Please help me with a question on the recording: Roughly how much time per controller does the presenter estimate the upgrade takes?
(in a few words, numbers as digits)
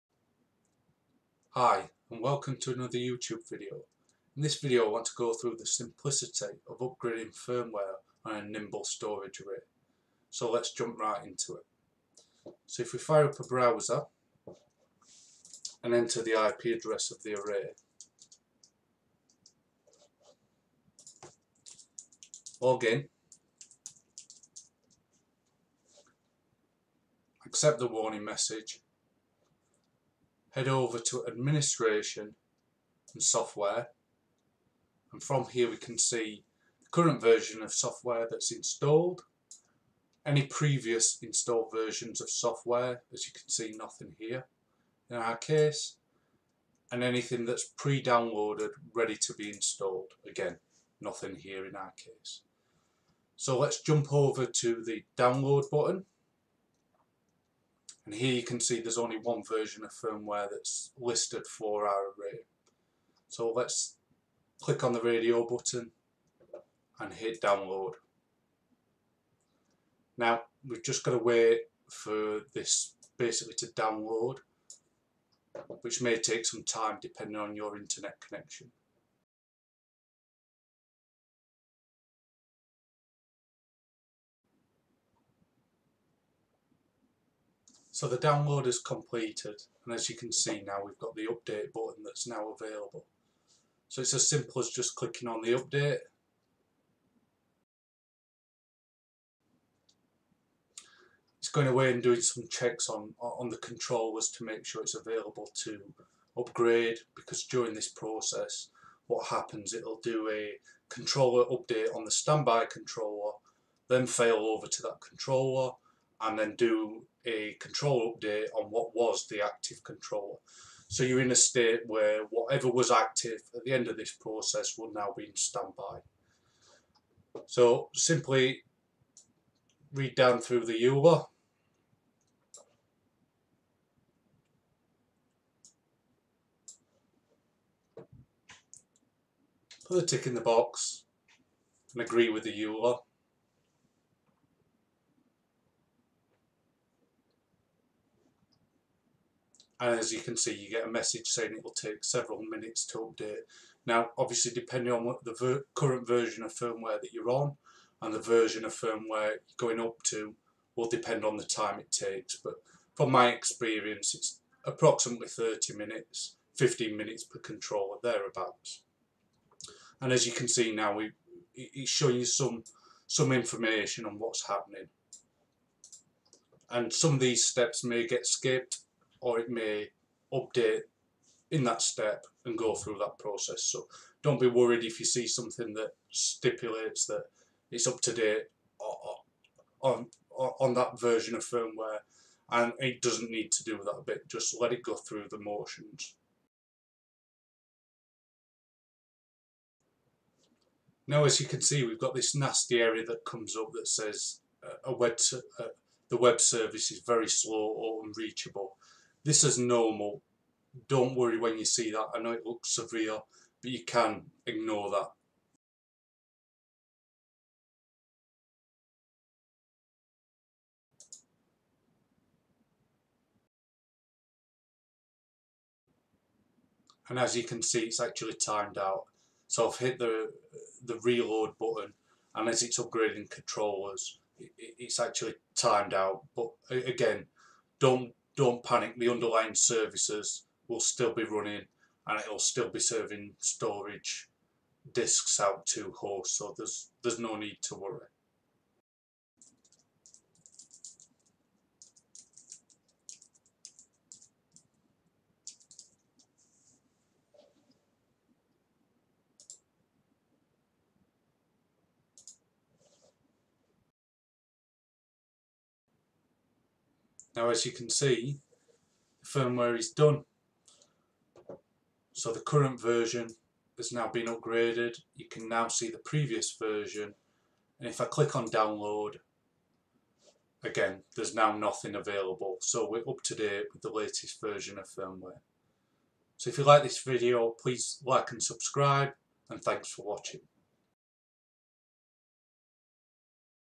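15 minutes.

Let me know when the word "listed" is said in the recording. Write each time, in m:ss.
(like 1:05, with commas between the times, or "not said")
1:00.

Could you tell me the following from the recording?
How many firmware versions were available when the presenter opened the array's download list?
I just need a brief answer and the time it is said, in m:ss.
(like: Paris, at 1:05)
1, at 0:58.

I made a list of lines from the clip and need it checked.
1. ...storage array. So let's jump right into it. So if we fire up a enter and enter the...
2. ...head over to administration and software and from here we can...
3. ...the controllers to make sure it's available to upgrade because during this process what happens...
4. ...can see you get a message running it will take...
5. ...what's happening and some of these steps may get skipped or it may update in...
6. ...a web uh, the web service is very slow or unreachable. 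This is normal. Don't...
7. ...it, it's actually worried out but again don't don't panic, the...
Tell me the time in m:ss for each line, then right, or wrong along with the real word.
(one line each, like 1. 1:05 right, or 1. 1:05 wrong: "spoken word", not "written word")
1. 0:08 wrong: "browser", not "enter"
2. 0:30 right
3. 1:43 right
4. 2:30 wrong: "saying", not "running"
5. 2:54 right
6. 3:24 right
7. 3:54 wrong: "timed", not "worried".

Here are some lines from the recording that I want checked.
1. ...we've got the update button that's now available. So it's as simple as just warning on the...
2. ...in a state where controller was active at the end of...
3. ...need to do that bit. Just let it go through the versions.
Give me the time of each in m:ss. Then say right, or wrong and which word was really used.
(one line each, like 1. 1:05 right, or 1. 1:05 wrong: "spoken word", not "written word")
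1. 1:30 wrong: "clicking", not "warning"
2. 2:01 wrong: "whatever", not "controller"
3. 3:13 wrong: "motions", not "versions".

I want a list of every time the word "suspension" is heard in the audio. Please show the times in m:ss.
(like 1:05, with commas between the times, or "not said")
not said.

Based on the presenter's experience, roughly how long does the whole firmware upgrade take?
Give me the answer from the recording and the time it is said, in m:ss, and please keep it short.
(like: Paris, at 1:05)
30 minutes, at 2:45.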